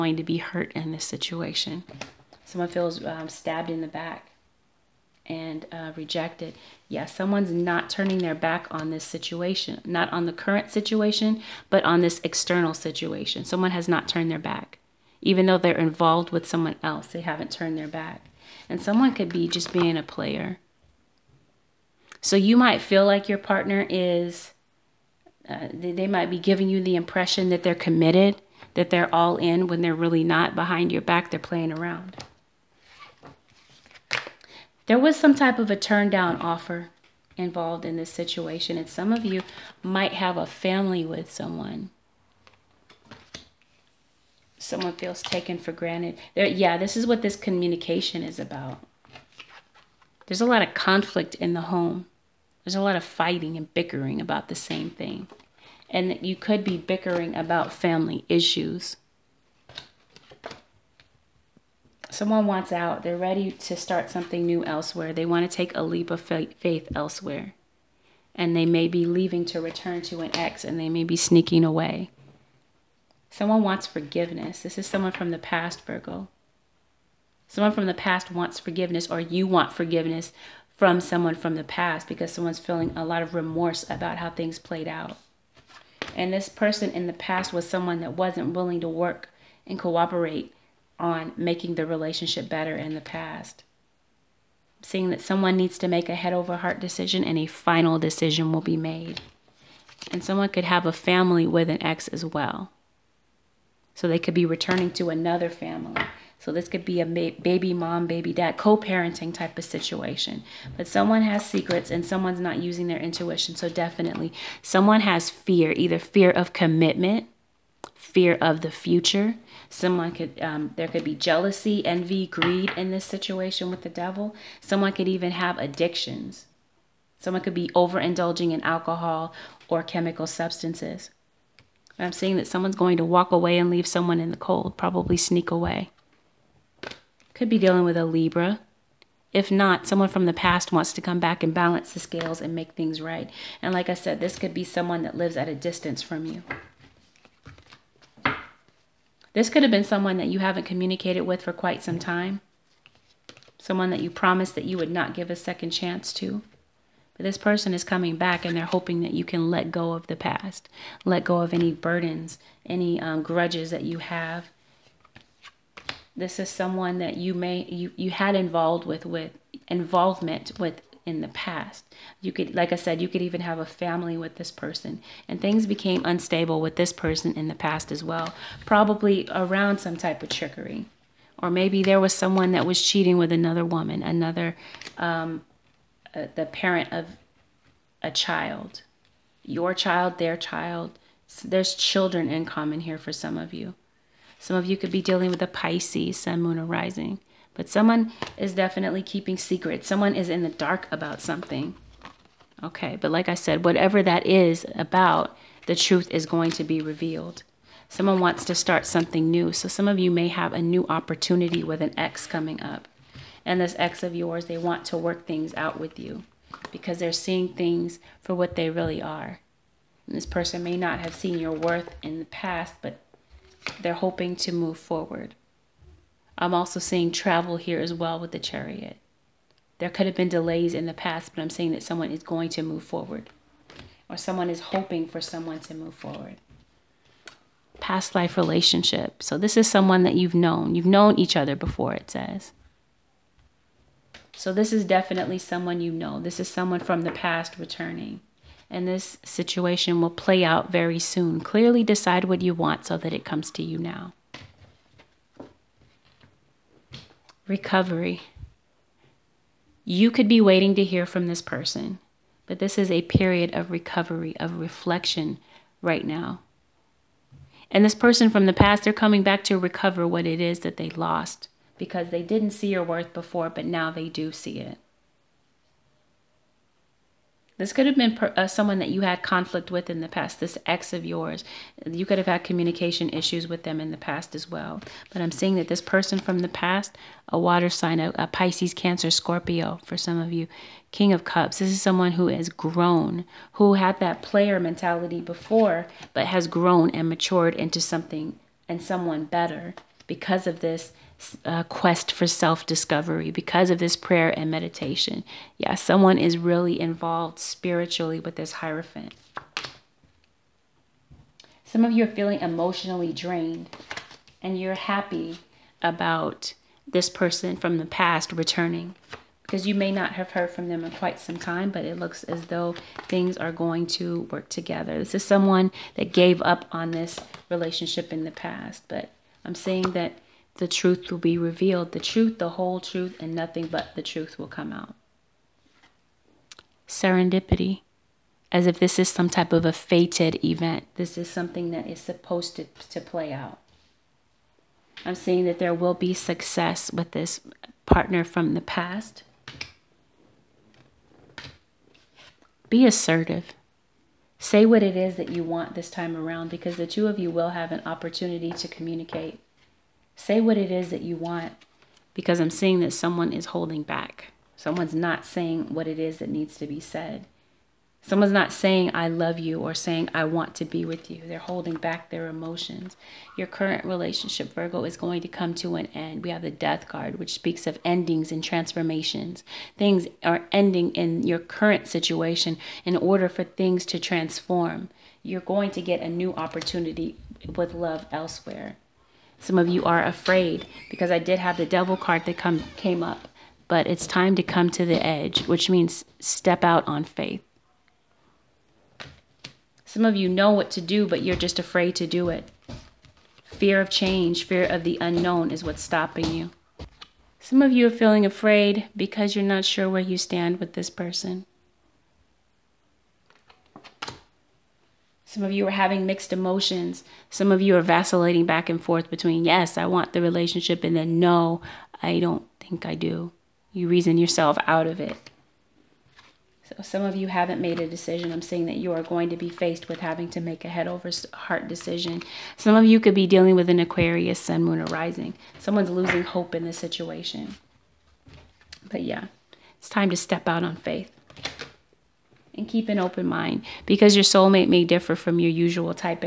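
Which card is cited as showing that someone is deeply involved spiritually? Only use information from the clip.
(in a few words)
Hierophant.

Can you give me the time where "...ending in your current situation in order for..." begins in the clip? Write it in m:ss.
6:20.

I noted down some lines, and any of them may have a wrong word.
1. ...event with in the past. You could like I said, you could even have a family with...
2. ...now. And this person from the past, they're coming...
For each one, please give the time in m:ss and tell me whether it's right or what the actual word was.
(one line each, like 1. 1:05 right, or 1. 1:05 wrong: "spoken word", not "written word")
1. 2:49 wrong: "involvement", not "event"
2. 4:26 right.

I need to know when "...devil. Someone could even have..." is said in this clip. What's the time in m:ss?
2:03.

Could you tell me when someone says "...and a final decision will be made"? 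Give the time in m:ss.
1:37.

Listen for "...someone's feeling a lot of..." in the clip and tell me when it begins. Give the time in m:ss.
1:22.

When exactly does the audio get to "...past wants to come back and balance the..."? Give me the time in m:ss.
2:20.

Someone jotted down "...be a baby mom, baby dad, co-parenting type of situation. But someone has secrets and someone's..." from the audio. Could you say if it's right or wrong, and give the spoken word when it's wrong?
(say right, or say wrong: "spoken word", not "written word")
right.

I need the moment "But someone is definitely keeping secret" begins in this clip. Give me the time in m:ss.
3:17.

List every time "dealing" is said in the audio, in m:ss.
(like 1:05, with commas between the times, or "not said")
2:17, 3:15, 7:13.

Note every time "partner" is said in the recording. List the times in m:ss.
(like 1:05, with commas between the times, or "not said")
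0:23, 5:47.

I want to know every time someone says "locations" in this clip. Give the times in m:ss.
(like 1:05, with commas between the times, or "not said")
not said.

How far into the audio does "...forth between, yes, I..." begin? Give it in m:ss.
6:58.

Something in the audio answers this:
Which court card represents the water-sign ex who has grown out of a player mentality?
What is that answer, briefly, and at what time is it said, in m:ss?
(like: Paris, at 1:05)
King of Cups, at 4:50.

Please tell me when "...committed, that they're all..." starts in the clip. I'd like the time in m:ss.
0:27.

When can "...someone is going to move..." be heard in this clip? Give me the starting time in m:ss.
3:51.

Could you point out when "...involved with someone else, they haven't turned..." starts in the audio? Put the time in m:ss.
0:15.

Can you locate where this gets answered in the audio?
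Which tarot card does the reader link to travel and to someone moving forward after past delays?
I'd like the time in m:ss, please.
3:48.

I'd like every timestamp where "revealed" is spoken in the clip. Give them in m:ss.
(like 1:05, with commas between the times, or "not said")
3:26, 5:31.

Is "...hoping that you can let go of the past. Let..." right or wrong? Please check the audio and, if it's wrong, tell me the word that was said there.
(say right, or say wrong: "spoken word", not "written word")
right.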